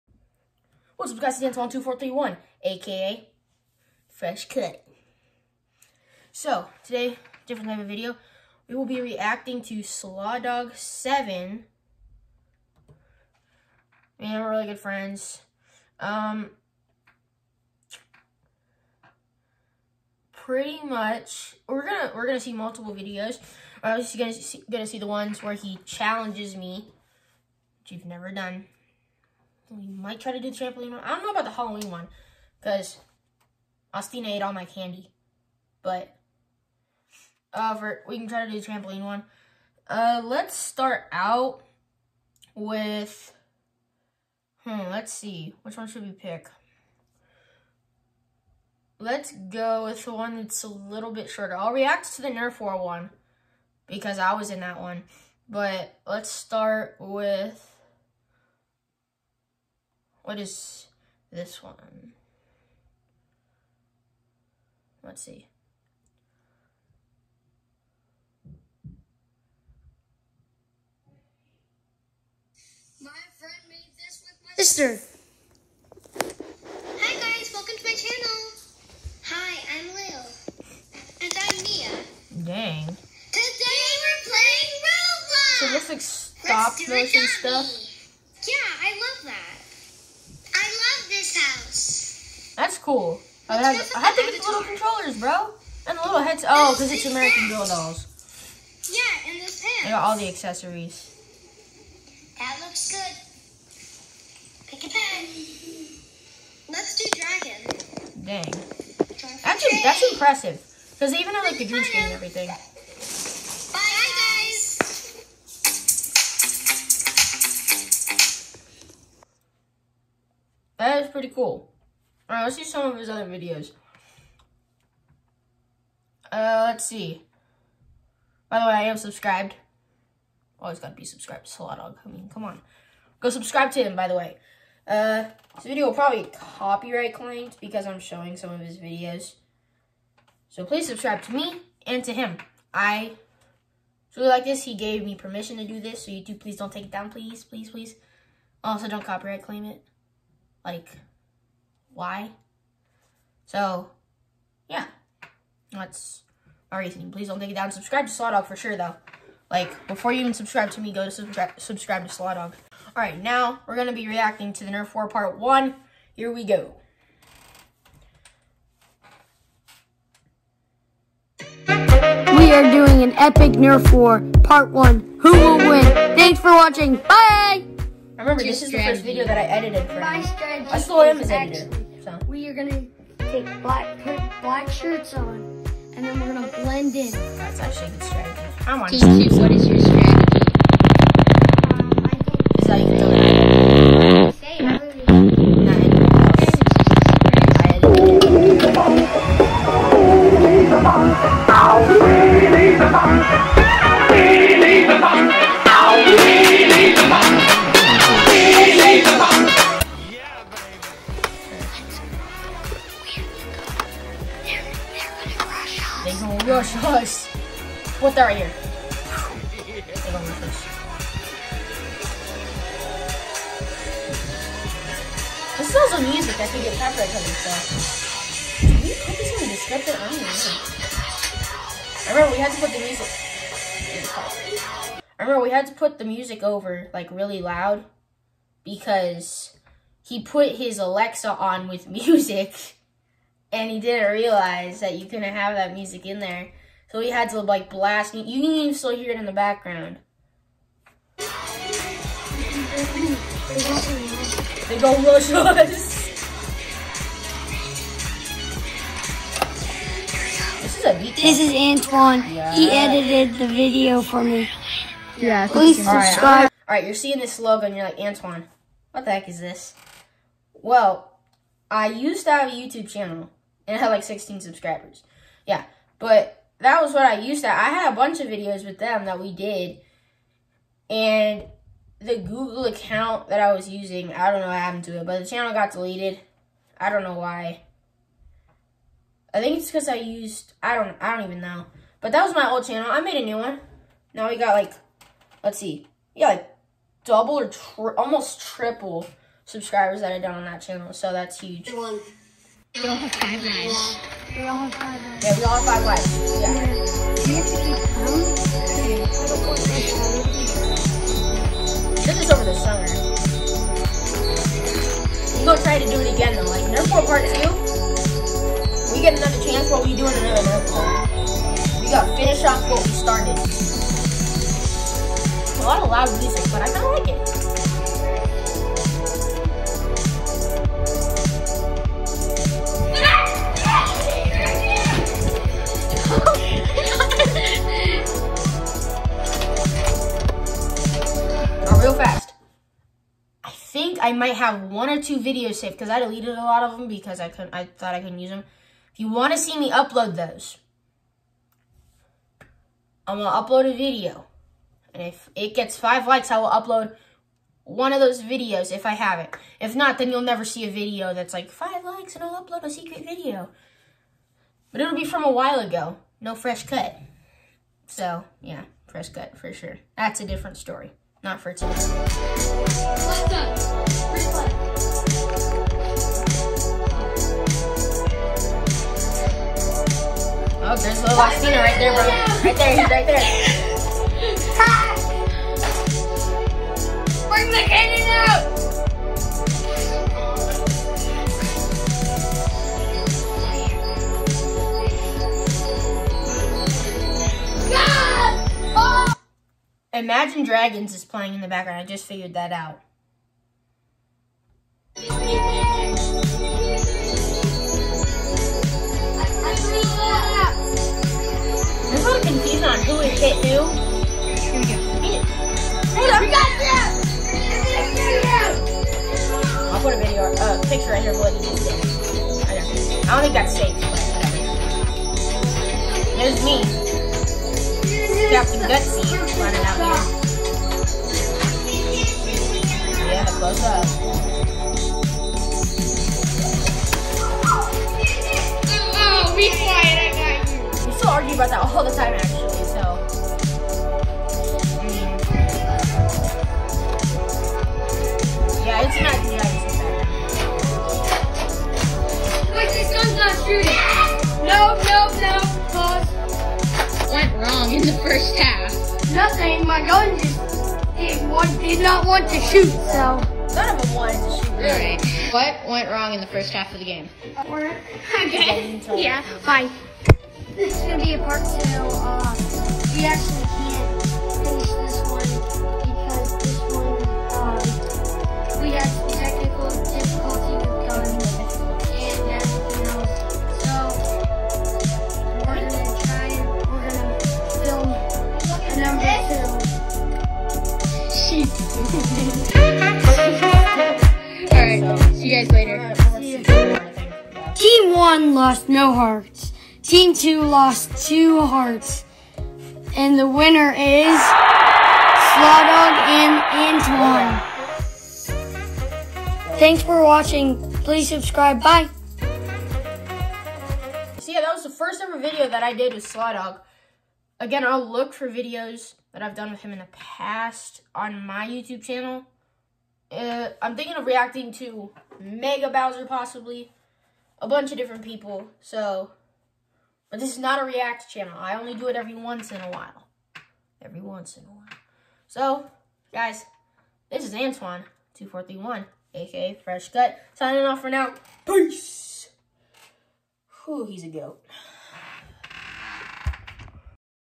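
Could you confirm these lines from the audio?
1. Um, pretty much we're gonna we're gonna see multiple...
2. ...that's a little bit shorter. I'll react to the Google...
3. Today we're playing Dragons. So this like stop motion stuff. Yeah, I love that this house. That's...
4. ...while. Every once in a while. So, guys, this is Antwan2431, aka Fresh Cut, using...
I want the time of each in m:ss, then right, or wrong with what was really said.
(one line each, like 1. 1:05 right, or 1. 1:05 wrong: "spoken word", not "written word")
1. 0:15 right
2. 0:50 wrong: "Nerf", not "Google"
3. 1:22 wrong: "Roblox", not "Dragons"
4. 8:52 wrong: "signing", not "using".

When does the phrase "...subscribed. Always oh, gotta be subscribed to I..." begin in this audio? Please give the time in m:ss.
2:08.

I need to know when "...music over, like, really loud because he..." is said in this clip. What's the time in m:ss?
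3:56.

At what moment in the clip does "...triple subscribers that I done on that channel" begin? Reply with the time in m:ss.
4:58.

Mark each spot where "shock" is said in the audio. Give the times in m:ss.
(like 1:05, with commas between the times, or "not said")
not said.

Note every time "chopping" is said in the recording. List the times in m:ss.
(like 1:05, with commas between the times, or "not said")
not said.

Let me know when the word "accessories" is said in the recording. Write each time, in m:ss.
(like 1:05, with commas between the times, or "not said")
1:40.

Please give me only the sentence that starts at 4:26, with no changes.
All all right, you're seeing this logo and you're like, Antwan, what the heck is this?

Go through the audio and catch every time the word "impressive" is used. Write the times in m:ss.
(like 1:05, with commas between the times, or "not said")
1:50.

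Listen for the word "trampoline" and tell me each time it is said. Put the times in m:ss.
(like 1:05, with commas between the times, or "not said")
0:30, 0:38.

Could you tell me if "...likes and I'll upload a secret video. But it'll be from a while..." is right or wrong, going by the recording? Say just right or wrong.
right.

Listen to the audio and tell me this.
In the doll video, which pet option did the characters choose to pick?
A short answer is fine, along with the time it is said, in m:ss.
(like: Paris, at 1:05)
Dragon, at 1:47.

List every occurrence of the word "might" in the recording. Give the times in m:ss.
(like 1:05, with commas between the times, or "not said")
0:29, 5:44.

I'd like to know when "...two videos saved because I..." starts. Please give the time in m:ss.
5:45.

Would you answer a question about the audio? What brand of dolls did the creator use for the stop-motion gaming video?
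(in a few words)
American Girl.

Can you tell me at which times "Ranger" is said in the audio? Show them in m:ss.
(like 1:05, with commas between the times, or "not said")
not said.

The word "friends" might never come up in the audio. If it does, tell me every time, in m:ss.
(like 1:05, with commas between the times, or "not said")
0:14, 1:13.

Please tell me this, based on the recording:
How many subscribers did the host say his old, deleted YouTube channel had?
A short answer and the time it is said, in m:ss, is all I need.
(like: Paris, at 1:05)
16, at 4:34.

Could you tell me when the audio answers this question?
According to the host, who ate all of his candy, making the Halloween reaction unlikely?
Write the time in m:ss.
0:33.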